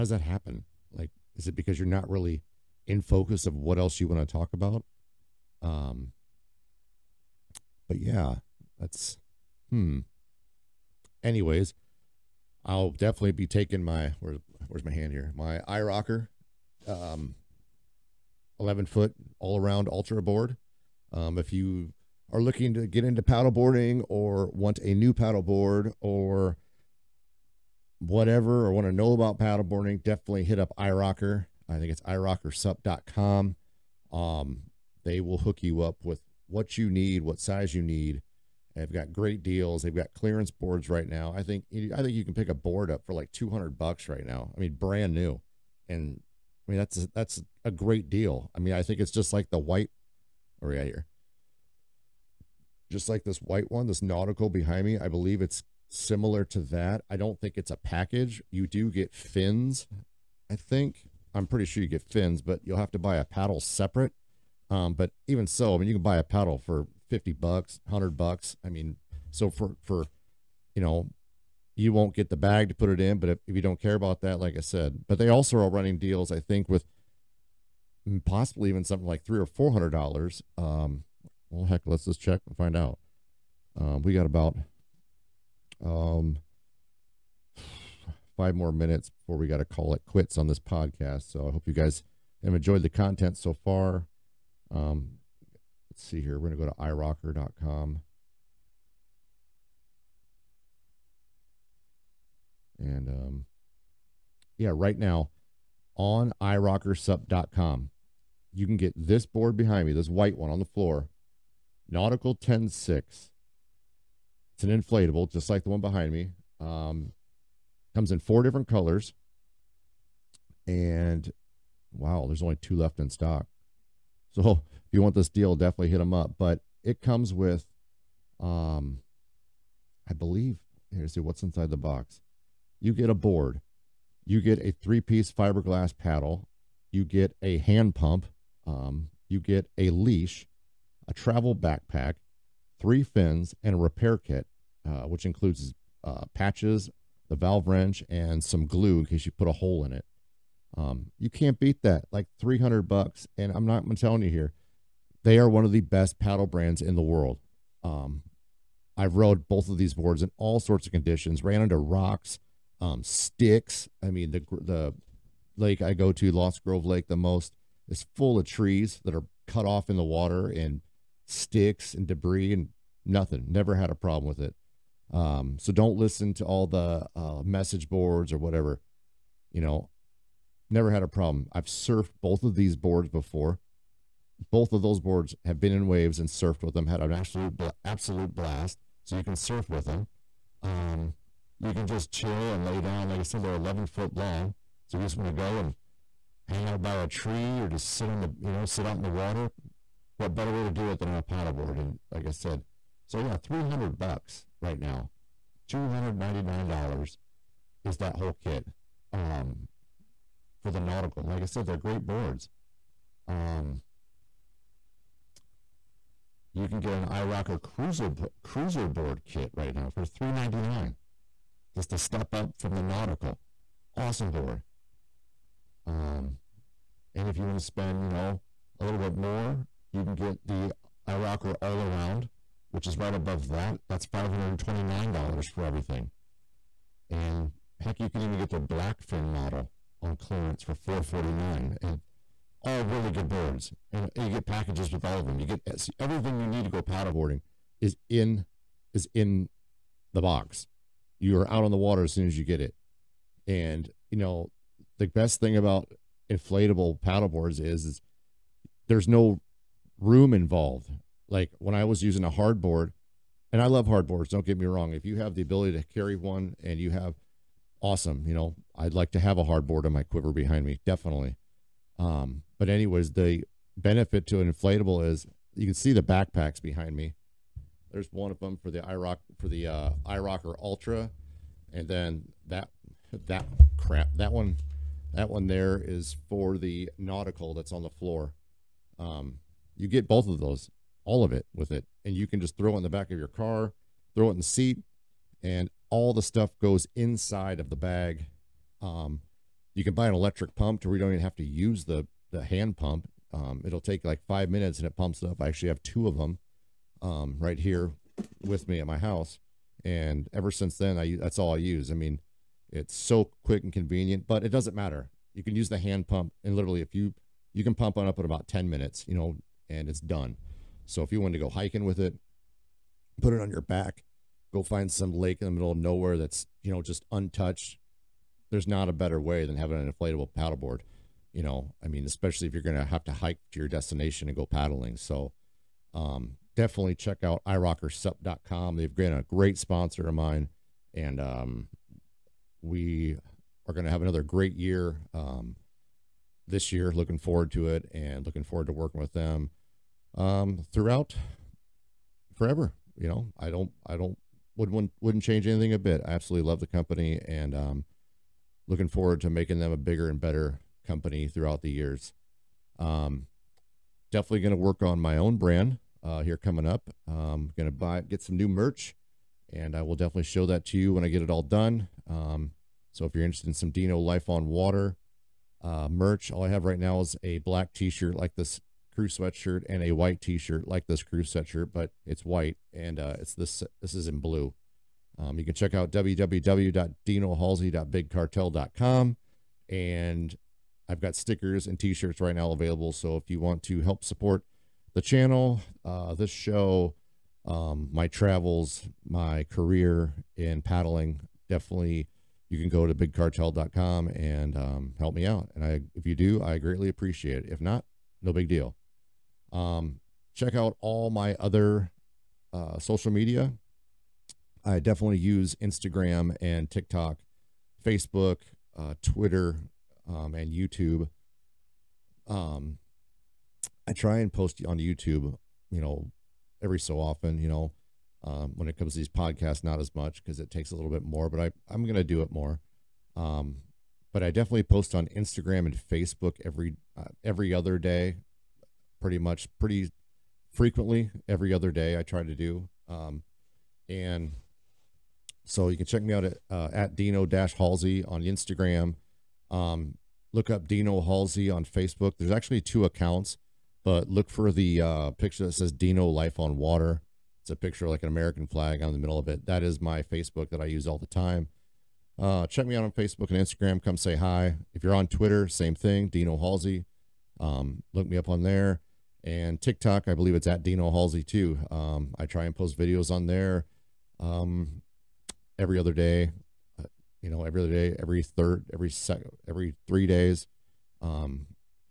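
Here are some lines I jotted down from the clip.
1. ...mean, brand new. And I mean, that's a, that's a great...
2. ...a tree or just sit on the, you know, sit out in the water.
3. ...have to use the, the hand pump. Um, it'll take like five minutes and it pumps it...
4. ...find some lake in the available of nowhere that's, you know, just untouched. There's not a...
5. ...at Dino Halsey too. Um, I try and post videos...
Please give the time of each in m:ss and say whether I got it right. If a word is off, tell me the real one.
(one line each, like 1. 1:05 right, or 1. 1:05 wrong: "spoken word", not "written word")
1. 0:44 right
2. 3:16 right
3. 5:01 right
4. 5:24 wrong: "middle", not "available"
5. 7:50 right.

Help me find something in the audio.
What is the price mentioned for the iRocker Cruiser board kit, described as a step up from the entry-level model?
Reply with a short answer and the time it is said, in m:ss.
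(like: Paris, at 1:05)
$399, at 3:40.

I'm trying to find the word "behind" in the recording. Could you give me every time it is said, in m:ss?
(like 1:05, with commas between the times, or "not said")
0:54, 1:49, 1:55, 4:30, 4:36.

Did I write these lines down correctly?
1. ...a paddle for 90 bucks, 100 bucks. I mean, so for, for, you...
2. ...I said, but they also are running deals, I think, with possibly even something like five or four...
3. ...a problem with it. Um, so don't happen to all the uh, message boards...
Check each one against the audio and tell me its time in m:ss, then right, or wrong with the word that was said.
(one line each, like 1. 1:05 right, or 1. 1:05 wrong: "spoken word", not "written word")
1. 1:06 wrong: "50", not "90"
2. 1:14 wrong: "three", not "five"
3. 2:53 wrong: "listen", not "happen".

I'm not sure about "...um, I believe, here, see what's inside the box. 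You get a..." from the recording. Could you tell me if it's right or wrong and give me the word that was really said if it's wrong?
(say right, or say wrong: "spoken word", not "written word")
right.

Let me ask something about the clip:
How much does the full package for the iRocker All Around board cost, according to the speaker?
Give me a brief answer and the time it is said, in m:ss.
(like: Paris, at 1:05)
$529, at 3:54.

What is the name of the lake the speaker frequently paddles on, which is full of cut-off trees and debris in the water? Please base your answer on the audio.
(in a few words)
Lost Grove Lake.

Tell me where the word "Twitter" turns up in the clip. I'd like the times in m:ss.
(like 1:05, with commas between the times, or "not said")
6:59, 7:45.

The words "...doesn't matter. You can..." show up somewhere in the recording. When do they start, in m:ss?
5:14.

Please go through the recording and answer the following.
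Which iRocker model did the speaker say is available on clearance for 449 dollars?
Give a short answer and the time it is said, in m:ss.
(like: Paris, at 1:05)
Blackfin, at 3:58.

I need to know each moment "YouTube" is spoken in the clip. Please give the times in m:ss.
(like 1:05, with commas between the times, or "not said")
7:00, 7:04.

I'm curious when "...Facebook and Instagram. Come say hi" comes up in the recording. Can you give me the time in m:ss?
7:42.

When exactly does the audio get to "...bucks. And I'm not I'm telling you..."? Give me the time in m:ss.
2:32.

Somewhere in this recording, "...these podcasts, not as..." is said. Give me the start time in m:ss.
7:08.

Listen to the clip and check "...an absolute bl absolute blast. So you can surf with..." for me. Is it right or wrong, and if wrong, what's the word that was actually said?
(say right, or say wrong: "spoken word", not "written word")
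right.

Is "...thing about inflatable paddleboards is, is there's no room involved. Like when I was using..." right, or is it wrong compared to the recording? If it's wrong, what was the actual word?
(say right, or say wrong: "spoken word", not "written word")
right.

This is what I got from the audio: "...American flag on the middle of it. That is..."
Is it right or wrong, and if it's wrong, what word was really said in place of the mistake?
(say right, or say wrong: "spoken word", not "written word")
right.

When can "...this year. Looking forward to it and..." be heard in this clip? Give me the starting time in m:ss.
5:46.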